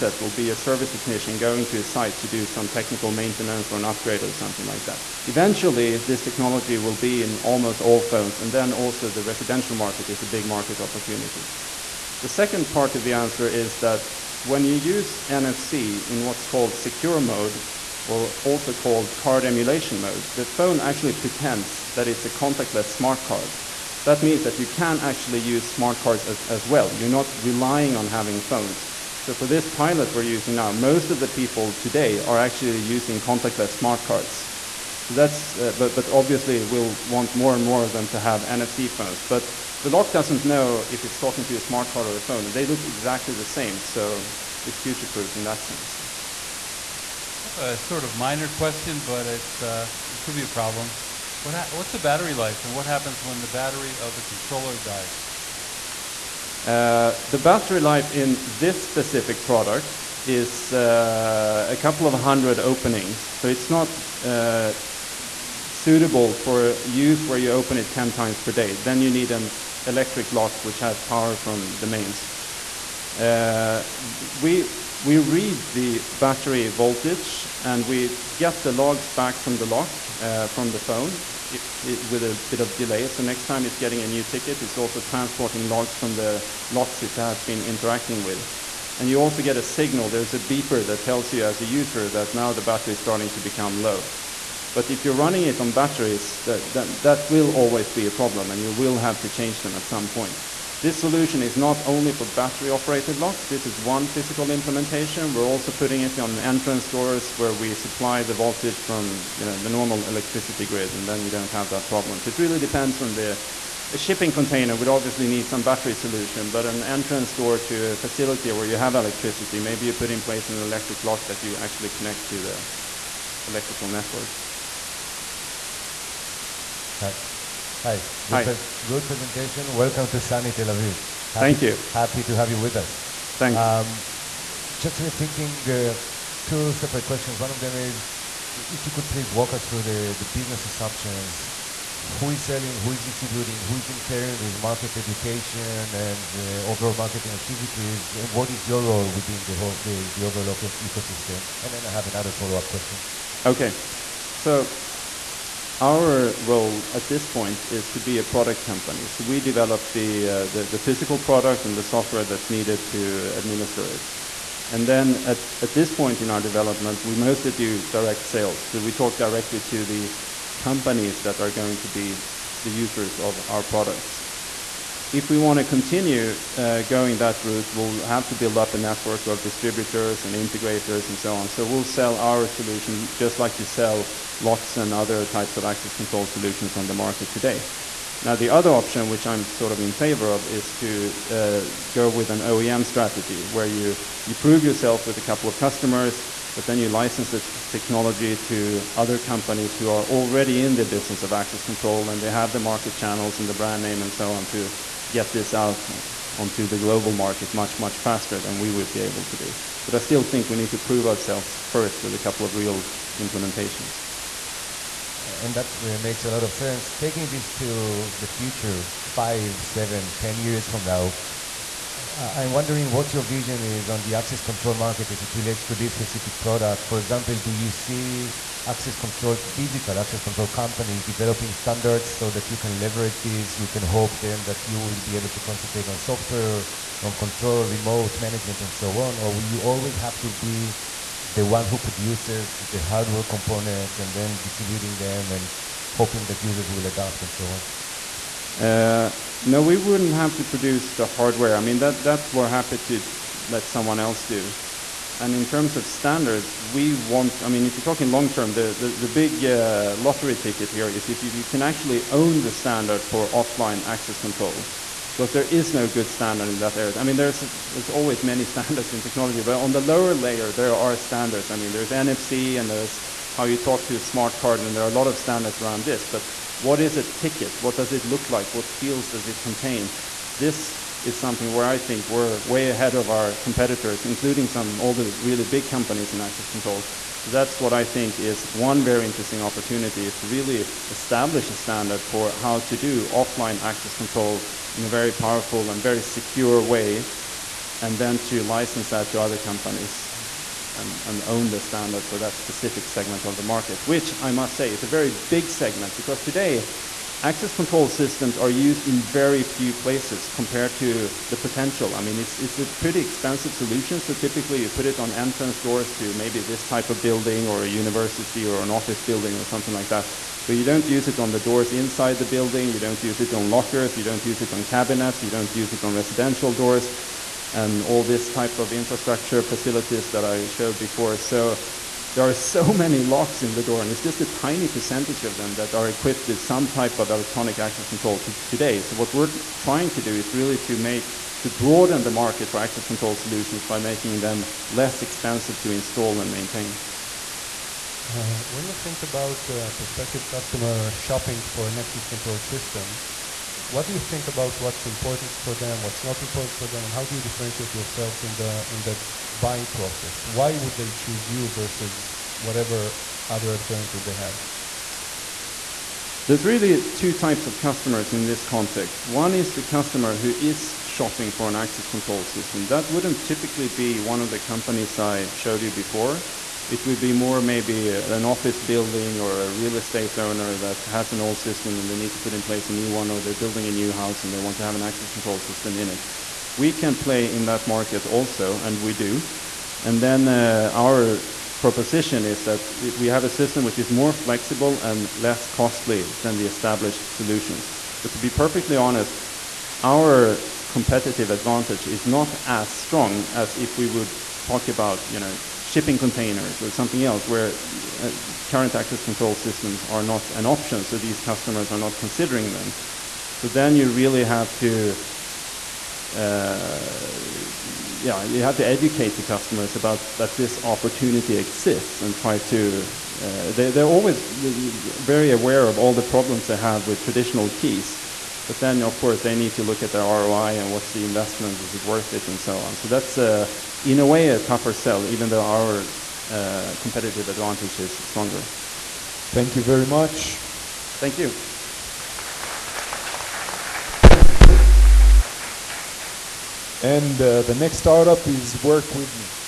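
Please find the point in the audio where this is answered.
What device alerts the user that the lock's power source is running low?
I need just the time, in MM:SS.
01:30.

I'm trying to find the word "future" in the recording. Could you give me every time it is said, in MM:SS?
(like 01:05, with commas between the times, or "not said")
00:44, 03:38.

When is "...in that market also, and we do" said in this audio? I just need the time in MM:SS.
06:27.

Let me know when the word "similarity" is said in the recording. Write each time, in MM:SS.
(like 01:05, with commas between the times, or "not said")
not said.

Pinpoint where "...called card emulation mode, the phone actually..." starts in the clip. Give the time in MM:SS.
00:18.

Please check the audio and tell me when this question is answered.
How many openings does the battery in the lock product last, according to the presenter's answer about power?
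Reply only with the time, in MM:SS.
01:01.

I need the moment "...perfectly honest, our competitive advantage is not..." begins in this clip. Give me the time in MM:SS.
06:38.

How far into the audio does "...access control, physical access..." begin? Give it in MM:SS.
03:48.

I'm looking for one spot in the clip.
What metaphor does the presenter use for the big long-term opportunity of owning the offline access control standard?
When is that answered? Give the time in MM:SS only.
04:19.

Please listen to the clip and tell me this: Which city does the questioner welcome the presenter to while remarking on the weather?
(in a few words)
Tel Aviv.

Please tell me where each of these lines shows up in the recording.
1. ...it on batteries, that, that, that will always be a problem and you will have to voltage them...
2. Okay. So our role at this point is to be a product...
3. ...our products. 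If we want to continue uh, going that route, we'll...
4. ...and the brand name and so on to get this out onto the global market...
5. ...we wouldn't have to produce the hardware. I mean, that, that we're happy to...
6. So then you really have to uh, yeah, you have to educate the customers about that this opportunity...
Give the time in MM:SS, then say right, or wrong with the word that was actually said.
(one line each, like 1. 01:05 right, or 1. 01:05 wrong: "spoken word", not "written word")
1. 01:35 wrong: "change", not "voltage"
2. 02:33 right
3. 02:53 right
4. 03:23 right
5. 04:09 right
6. 06:53 right.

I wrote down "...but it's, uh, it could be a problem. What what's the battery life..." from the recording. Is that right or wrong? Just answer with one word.
right.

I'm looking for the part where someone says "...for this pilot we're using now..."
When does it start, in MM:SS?
00:29.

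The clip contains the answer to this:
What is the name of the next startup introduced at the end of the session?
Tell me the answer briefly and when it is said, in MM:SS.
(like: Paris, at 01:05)
Work With, at 07:28.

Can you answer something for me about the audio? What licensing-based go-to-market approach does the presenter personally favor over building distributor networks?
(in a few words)
OEM strategy.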